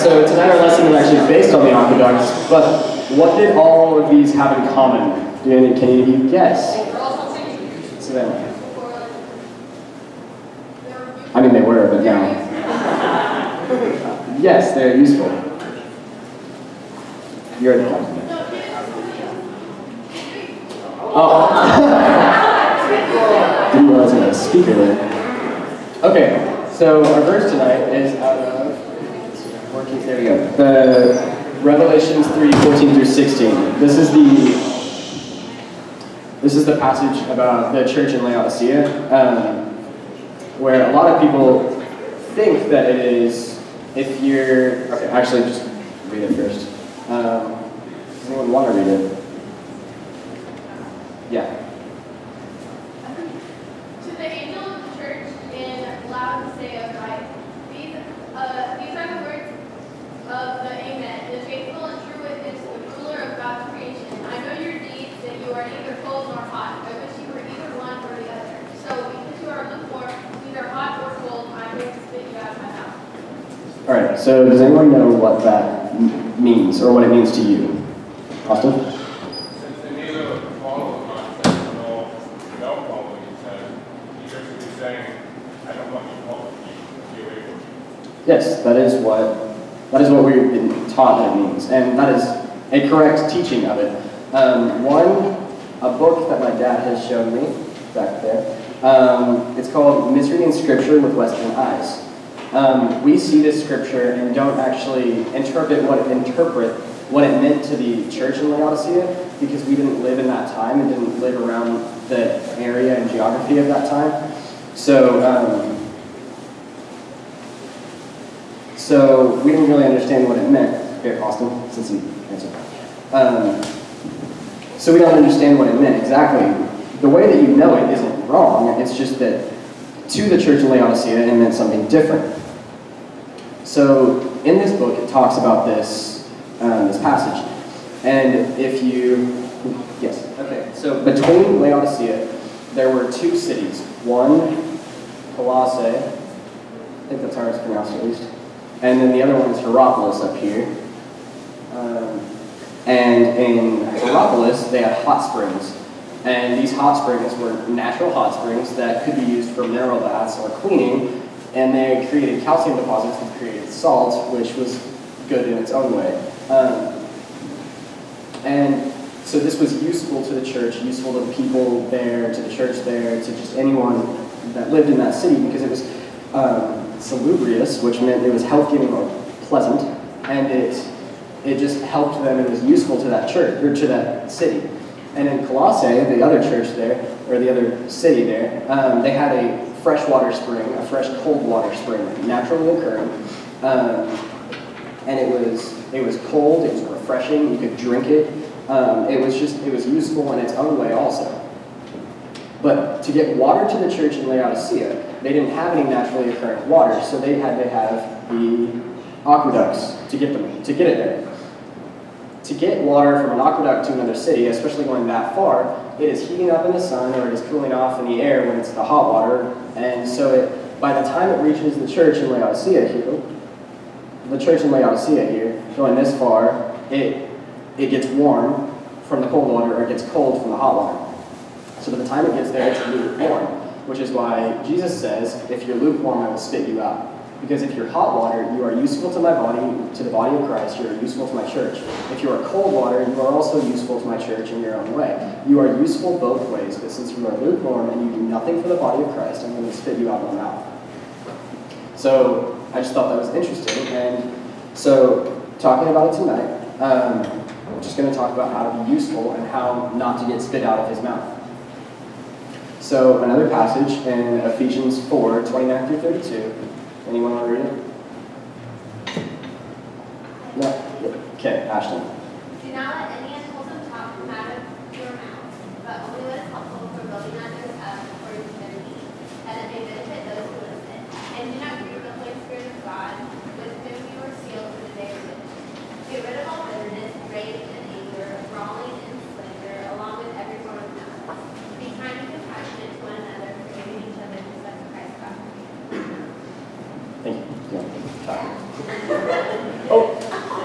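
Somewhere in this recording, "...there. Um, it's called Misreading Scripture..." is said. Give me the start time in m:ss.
1:38.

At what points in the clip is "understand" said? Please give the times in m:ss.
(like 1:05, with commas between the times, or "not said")
1:59, 2:05.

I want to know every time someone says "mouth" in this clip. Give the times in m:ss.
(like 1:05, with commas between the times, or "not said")
4:10, 4:21.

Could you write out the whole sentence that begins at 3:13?
Um, and it was, it was cold, it was refreshing, you could drink it.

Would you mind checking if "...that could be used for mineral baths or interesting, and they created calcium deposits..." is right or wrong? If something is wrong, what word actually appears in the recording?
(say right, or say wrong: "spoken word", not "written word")
wrong: "cleaning", not "interesting".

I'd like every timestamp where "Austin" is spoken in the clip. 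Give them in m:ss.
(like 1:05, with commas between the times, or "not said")
1:18, 2:01.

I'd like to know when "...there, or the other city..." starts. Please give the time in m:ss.
3:06.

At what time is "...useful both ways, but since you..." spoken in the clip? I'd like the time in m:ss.
4:05.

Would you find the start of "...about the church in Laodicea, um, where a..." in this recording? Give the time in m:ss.
0:37.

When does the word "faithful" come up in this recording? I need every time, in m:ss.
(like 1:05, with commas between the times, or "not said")
1:01.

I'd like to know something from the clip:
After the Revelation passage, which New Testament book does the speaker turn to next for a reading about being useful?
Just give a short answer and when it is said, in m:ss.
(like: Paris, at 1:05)
Ephesians, at 4:24.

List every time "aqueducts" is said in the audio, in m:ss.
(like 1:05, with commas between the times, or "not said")
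0:01, 3:29, 3:33.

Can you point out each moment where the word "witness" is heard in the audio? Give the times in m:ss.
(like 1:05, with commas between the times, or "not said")
1:02.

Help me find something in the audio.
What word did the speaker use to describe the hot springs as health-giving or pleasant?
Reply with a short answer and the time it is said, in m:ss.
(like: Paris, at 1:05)
salubrious, at 2:56.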